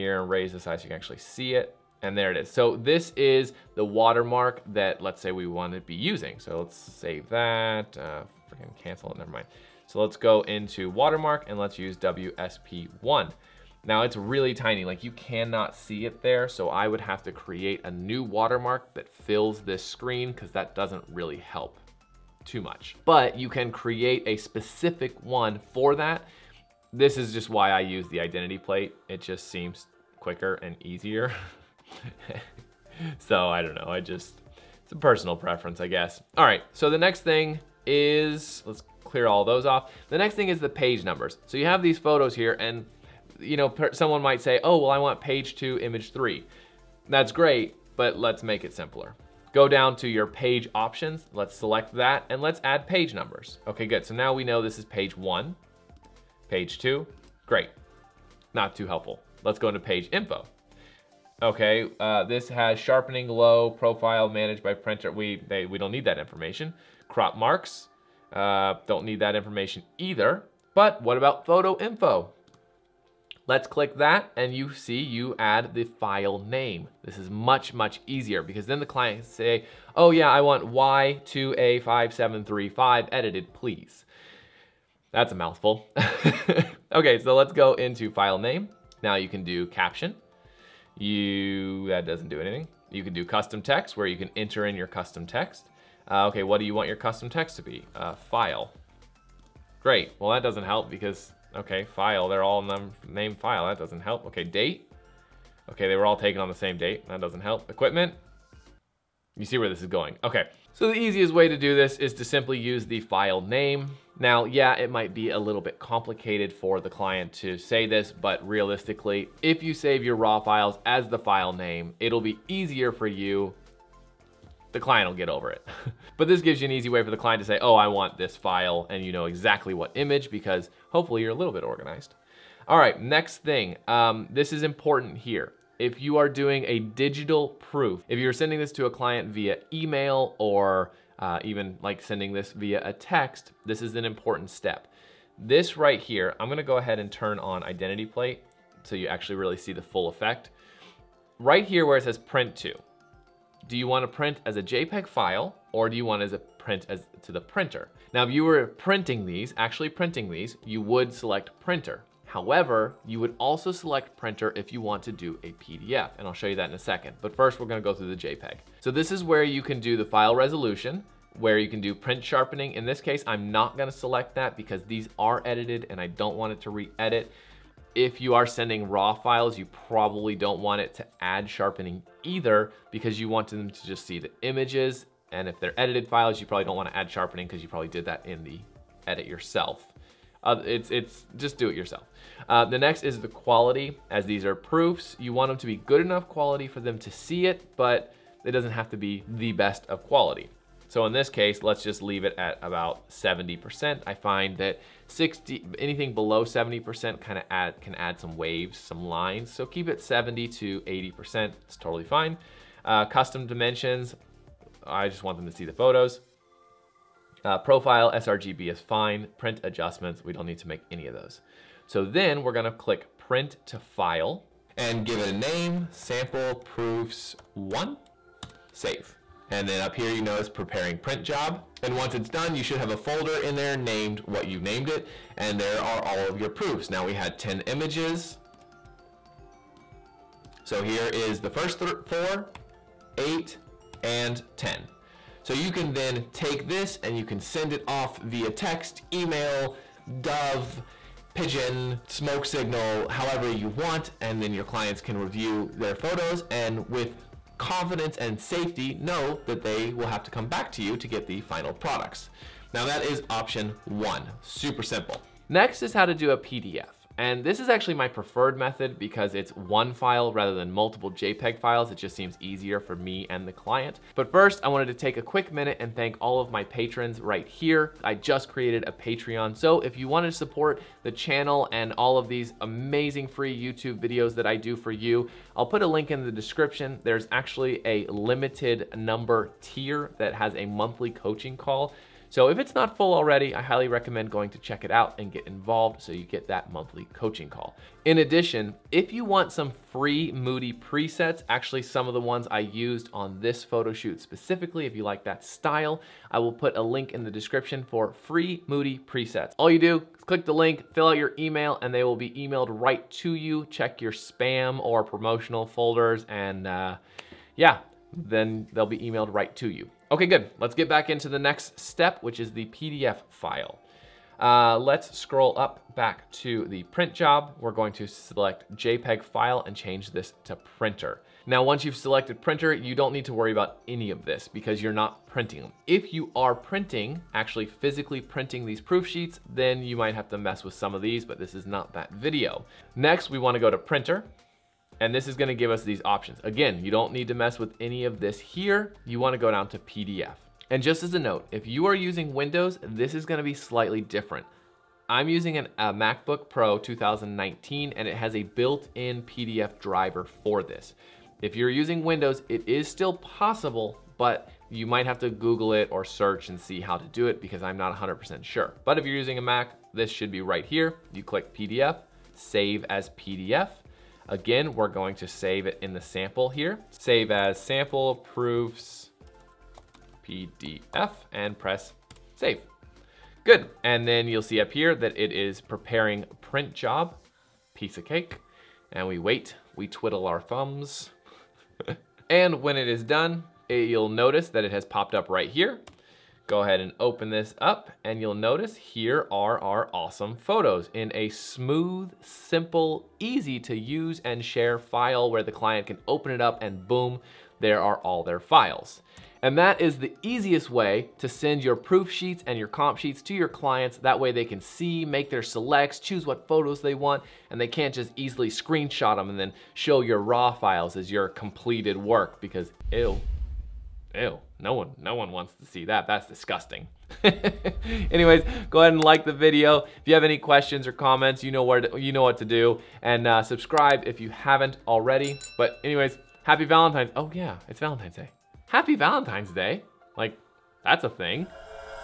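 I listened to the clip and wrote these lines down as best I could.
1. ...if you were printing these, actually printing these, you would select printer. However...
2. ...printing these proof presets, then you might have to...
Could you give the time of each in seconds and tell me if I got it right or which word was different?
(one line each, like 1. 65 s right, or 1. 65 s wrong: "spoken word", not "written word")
1. 158 s right
2. 338 s wrong: "sheets", not "presets".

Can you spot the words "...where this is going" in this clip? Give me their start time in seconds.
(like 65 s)
109 s.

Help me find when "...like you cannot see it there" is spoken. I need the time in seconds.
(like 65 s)
14 s.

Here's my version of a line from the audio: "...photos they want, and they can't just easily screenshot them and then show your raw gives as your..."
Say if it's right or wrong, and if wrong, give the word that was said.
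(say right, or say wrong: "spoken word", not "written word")
wrong: "files", not "gives".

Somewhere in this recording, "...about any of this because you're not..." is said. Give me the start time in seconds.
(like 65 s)
333 s.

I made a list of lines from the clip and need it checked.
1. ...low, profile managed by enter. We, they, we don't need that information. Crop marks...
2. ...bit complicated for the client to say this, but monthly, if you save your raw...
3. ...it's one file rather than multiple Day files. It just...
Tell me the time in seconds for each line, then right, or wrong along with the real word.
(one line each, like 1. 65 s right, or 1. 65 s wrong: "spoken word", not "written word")
1. 63 s wrong: "printer", not "enter"
2. 115 s wrong: "realistically", not "monthly"
3. 269 s wrong: "JPEG", not "Day".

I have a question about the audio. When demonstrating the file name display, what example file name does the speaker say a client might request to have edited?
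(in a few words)
Y2A5735.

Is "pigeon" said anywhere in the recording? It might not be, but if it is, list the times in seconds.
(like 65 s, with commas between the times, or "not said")
251 s.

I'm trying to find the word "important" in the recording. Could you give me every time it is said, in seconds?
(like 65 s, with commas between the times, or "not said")
134 s, 144 s.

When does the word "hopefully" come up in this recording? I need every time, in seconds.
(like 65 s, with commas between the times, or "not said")
130 s.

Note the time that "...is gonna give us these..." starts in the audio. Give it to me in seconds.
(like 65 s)
345 s.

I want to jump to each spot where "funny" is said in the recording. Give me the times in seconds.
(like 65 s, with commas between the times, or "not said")
not said.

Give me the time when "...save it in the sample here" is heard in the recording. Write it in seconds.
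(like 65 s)
375 s.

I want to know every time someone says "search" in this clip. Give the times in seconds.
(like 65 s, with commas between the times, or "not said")
366 s.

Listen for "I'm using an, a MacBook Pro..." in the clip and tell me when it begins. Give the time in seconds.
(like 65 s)
355 s.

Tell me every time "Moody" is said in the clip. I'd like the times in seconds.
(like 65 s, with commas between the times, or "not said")
300 s, 308 s.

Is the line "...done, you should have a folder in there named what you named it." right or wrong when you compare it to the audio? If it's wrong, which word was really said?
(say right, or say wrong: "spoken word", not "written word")
right.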